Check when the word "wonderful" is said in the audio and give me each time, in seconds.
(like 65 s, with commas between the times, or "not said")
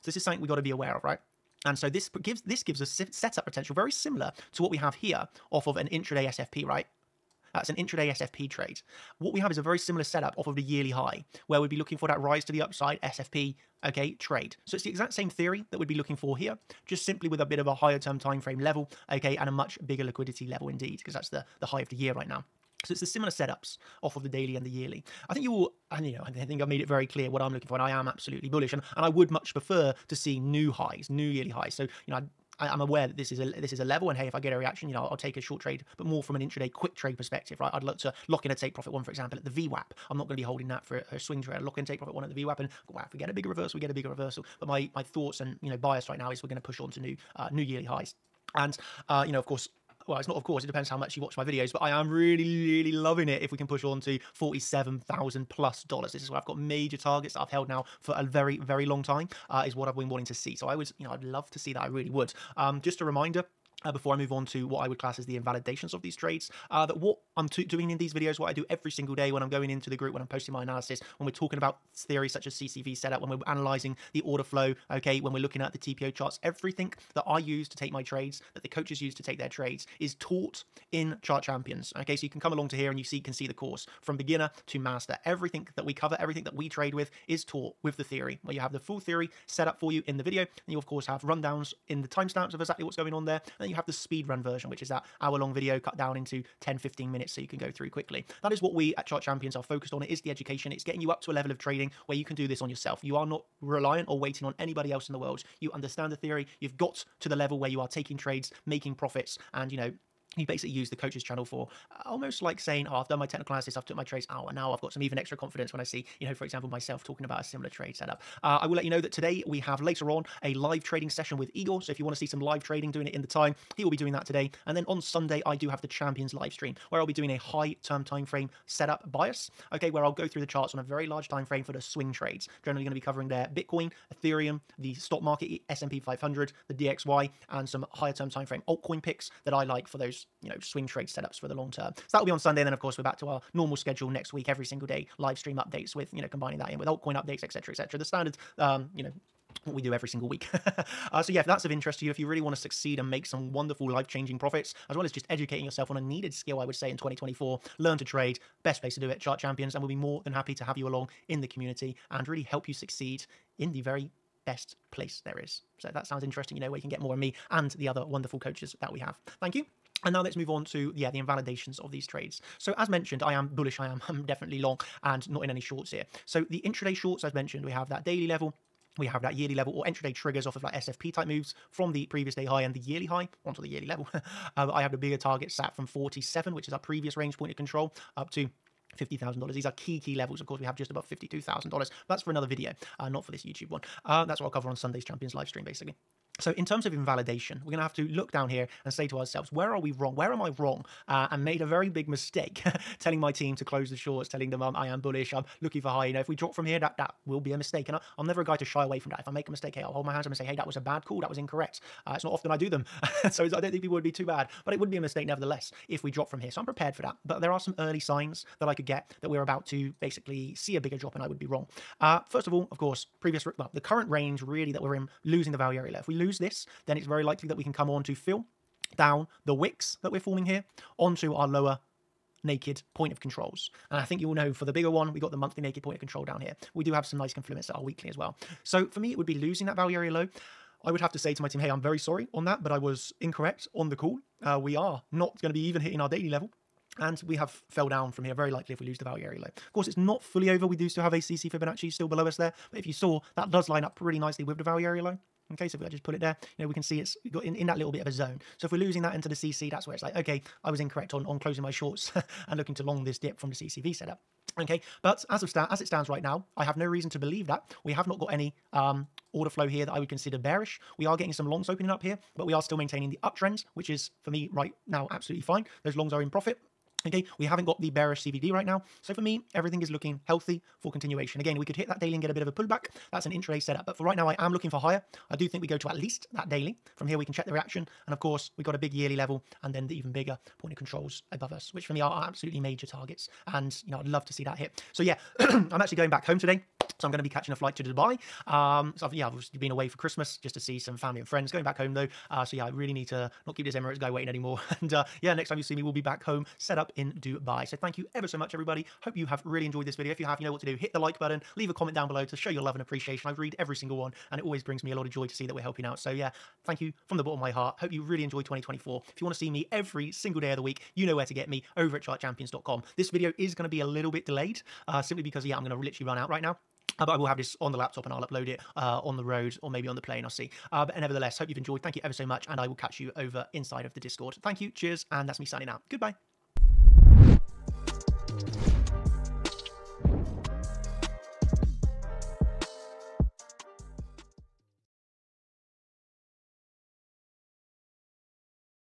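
153 s, 168 s.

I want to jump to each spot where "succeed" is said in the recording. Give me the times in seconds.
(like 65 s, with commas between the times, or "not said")
152 s, 162 s.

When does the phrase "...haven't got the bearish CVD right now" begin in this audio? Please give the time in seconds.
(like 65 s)
277 s.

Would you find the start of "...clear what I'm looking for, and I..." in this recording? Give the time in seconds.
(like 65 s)
27 s.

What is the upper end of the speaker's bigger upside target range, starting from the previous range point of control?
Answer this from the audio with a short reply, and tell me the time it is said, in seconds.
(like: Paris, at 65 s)
$50,000, at 188 s.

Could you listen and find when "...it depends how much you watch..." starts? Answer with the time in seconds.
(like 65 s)
50 s.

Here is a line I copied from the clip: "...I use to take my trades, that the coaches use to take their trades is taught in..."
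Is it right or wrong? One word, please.
right.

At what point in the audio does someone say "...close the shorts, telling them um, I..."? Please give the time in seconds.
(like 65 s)
203 s.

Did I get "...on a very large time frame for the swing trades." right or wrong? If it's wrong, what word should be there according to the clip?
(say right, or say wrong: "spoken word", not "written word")
right.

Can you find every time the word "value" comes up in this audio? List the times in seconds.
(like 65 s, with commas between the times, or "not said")
225 s, 239 s, 249 s, 254 s.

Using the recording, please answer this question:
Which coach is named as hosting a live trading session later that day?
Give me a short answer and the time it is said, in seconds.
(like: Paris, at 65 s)
Igor, at 121 s.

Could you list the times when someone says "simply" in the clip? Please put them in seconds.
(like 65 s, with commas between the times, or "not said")
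17 s, 325 s.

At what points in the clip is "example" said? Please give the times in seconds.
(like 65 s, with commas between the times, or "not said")
39 s, 116 s.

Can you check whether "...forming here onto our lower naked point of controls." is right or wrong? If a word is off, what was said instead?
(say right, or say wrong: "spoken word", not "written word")
right.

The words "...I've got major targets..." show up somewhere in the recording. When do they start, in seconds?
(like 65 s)
56 s.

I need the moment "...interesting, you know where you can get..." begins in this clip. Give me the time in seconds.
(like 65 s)
166 s.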